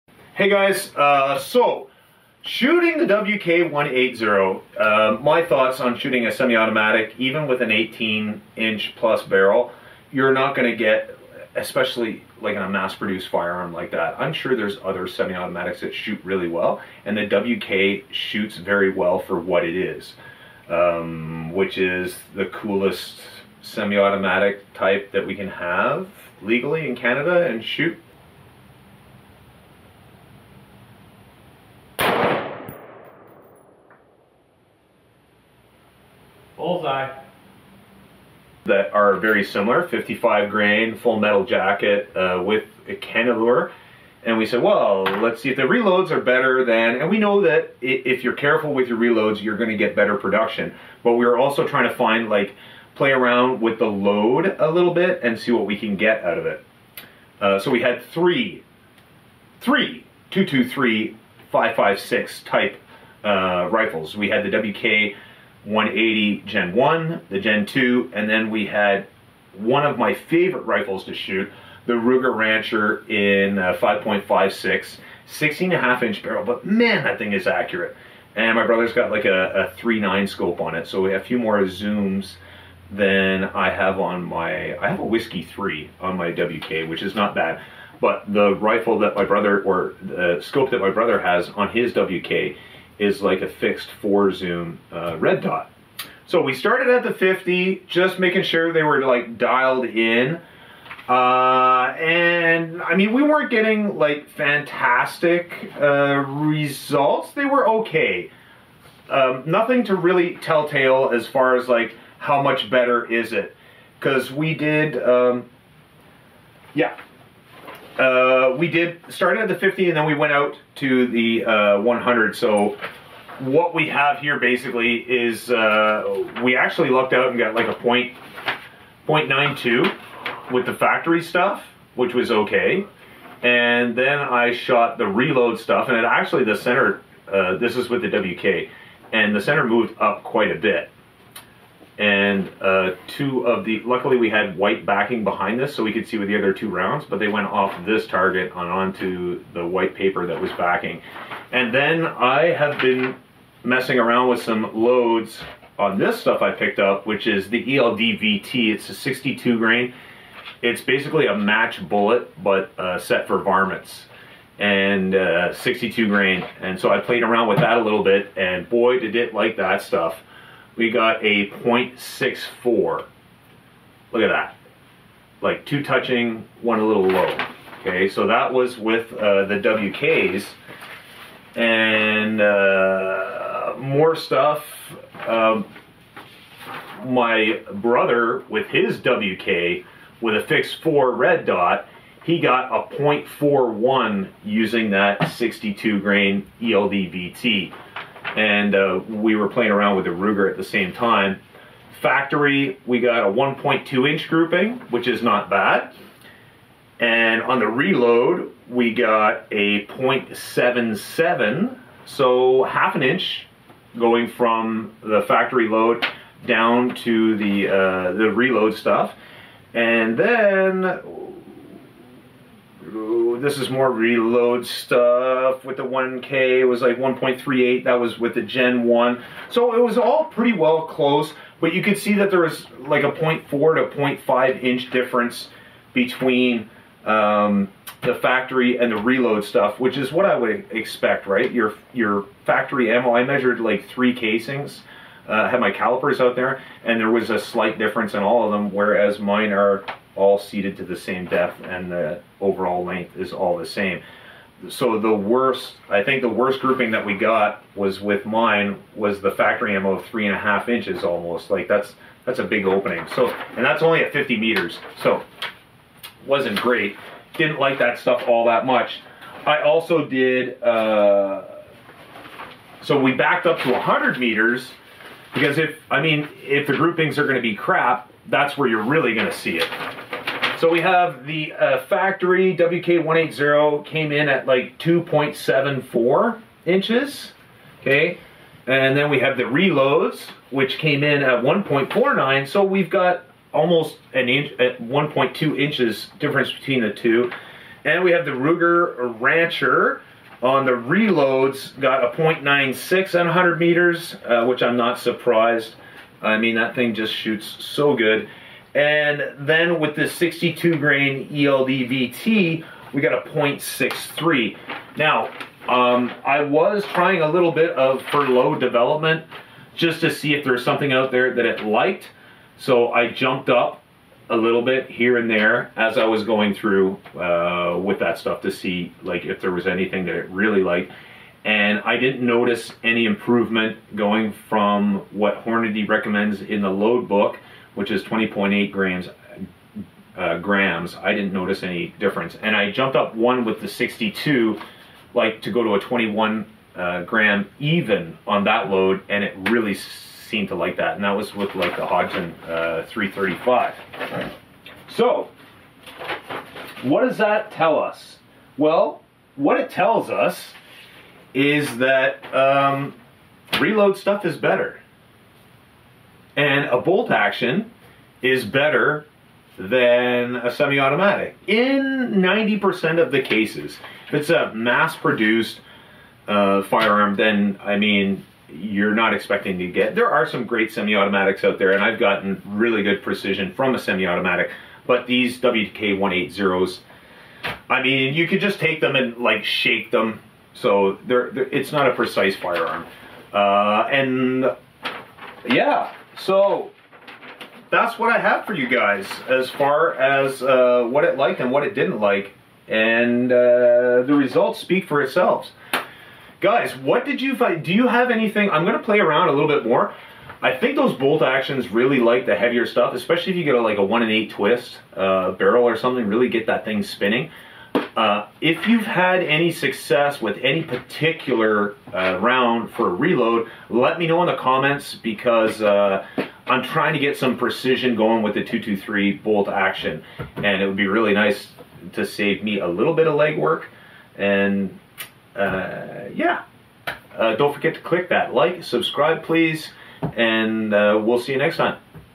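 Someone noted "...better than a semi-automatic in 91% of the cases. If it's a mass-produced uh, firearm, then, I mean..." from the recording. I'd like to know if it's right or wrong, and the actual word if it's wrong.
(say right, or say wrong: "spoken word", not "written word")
wrong: "90", not "91".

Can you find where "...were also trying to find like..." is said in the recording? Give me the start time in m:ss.
0:51.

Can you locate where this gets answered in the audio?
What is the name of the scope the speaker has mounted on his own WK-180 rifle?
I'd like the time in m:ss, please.
1:25.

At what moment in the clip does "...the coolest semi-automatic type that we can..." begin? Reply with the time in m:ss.
0:22.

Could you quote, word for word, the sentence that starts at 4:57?
And we have the Ruger Rancher on the reloads, got a 0.96 and 100 meters, uh, which I'm not surprised.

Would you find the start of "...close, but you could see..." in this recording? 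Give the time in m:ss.
3:50.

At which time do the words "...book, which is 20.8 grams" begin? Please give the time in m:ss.
5:37.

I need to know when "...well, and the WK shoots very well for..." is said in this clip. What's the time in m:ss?
0:16.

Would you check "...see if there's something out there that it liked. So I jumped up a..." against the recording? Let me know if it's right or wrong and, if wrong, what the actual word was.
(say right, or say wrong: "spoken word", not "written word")
right.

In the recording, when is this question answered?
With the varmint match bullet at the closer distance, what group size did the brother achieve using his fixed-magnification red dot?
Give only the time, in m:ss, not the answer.
3:12.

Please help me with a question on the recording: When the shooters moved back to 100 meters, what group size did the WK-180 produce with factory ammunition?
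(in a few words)
2.74 inches.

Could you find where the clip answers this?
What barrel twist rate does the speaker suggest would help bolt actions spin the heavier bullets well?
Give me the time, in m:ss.
6:53.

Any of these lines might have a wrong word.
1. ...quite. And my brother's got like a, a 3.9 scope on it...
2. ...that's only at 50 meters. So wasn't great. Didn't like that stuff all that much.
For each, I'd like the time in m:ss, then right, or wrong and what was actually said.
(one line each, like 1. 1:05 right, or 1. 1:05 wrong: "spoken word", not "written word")
1. 1:17 wrong: "accurate", not "quite"
2. 4:23 right.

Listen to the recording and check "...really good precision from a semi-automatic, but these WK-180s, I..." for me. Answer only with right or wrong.
right.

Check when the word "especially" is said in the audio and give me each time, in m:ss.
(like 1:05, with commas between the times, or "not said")
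0:11, 6:52.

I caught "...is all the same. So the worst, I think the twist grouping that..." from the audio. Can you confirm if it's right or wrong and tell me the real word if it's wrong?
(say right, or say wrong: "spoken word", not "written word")
wrong: "worst", not "twist".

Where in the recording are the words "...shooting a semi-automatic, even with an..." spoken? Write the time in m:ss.
0:05.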